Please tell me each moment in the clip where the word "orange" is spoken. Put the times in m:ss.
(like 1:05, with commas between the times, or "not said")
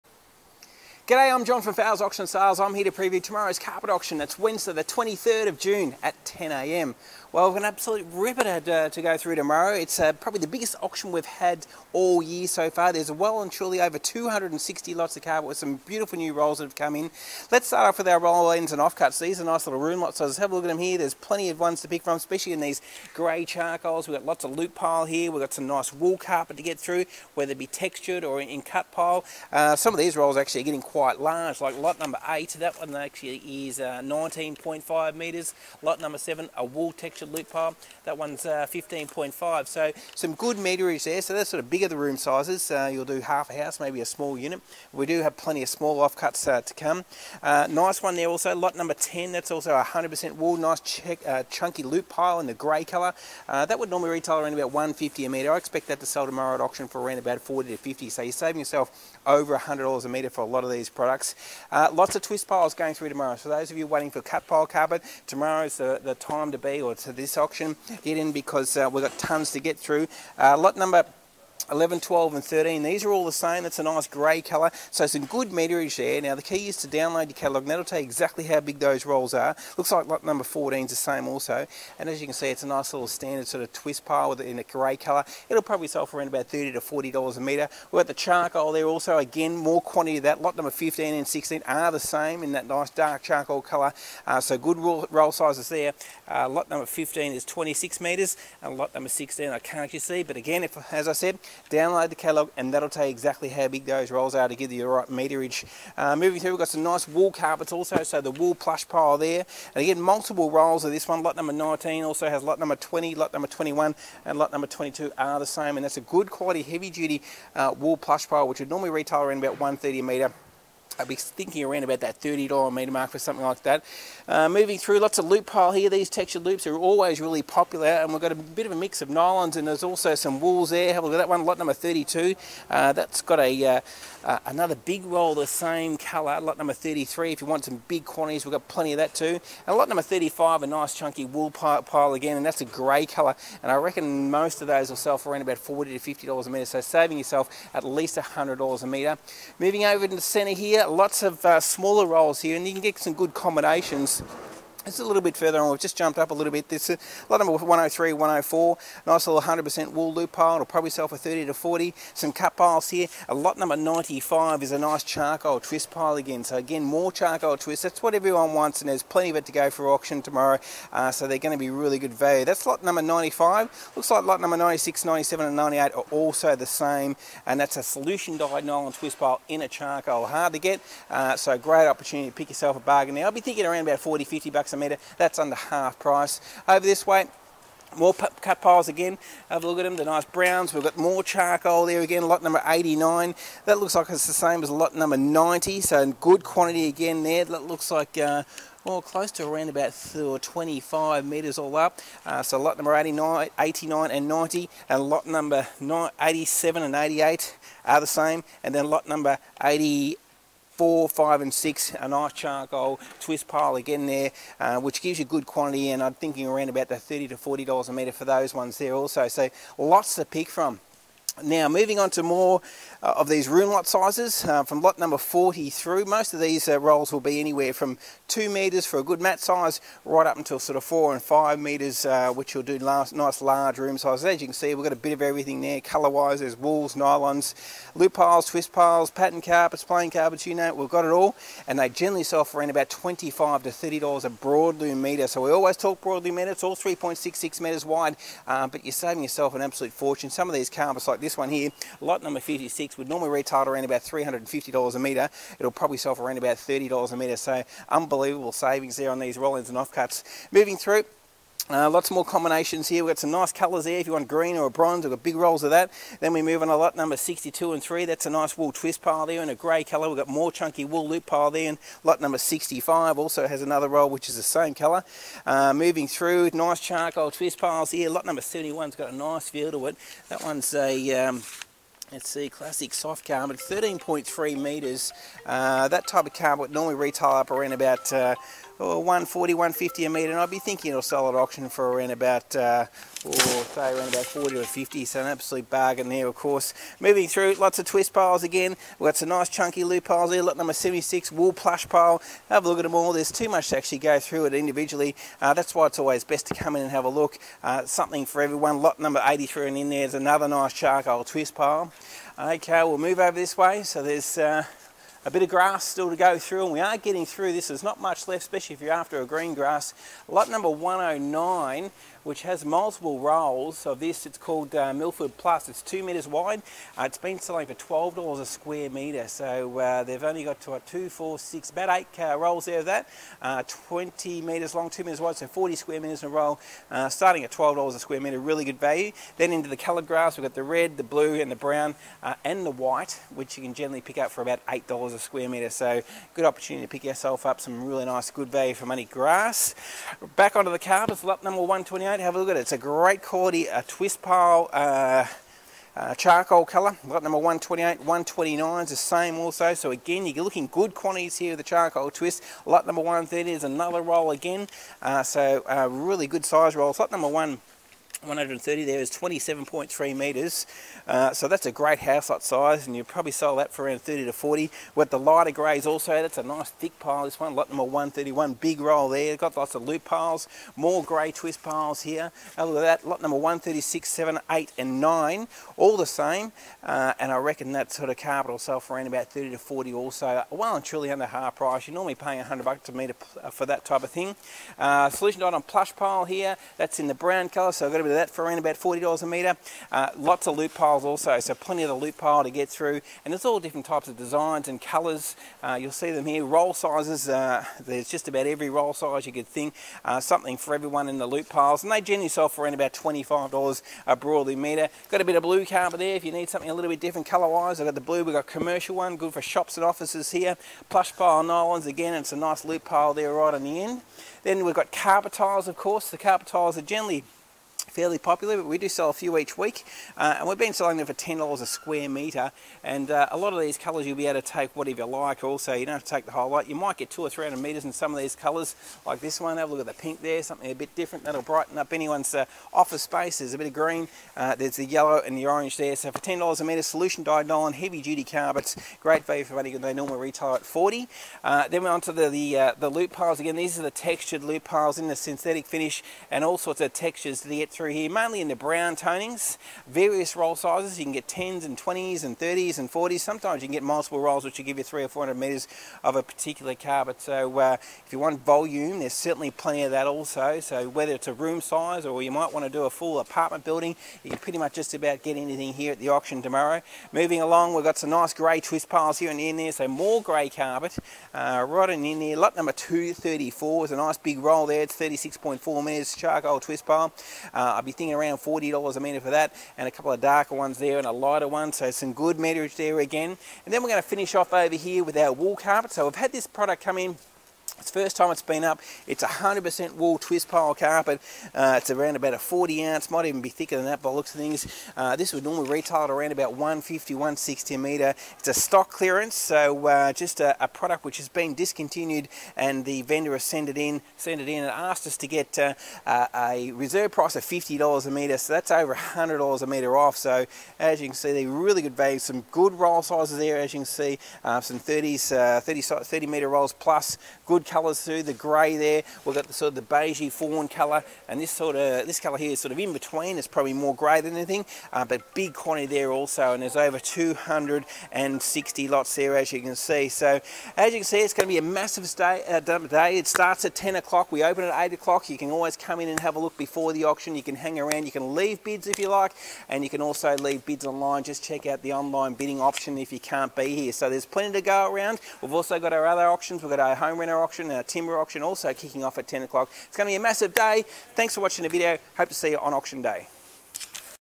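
7:25.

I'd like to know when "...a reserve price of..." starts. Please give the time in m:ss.
8:36.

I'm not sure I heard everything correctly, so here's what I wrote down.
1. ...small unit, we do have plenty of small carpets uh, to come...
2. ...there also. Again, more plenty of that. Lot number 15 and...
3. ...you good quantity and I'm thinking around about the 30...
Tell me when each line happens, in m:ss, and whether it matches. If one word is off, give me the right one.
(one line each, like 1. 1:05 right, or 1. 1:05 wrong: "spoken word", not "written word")
1. 0:44 wrong: "offcuts", not "carpets"
2. 1:28 wrong: "quantity", not "plenty"
3. 3:35 right.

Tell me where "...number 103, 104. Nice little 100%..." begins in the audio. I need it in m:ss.
2:37.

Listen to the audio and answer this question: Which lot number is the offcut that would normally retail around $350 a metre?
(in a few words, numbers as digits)
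56.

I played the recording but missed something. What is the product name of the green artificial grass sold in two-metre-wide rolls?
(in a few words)
Milford Plus.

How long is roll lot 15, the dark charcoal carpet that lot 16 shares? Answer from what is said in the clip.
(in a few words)
26 metres.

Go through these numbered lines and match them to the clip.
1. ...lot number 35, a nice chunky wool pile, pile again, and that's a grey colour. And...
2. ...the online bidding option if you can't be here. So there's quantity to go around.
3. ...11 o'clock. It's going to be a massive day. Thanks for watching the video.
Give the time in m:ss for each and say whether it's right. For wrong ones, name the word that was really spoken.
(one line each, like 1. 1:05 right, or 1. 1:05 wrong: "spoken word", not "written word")
1. 2:19 right
2. 9:11 wrong: "plenty", not "quantity"
3. 9:19 wrong: "10", not "11".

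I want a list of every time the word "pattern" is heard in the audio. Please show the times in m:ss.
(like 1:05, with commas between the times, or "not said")
3:59.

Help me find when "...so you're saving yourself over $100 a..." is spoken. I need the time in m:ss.
0:58.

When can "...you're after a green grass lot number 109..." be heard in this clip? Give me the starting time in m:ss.
5:18.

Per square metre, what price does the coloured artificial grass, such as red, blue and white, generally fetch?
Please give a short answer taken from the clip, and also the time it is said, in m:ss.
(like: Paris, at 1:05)
$8, at 5:44.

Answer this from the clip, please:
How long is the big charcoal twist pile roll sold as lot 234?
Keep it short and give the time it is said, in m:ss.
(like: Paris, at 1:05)
36.4 metres, at 8:04.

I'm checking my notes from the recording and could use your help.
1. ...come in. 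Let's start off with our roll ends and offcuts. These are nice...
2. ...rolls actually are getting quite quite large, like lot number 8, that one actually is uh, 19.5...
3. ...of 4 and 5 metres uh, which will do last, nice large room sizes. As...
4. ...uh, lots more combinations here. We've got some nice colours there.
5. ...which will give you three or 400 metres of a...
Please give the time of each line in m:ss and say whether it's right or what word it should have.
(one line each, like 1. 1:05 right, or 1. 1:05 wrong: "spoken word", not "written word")
1. 0:16 right
2. 0:30 right
3. 3:50 right
4. 4:21 right
5. 7:44 right.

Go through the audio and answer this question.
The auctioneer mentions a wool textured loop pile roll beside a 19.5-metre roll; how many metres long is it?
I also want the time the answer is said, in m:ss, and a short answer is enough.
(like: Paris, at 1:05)
15.5, at 0:38.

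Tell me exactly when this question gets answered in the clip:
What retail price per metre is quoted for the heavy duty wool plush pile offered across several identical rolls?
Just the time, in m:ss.
1:59.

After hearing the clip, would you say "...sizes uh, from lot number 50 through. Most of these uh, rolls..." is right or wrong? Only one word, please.
wrong.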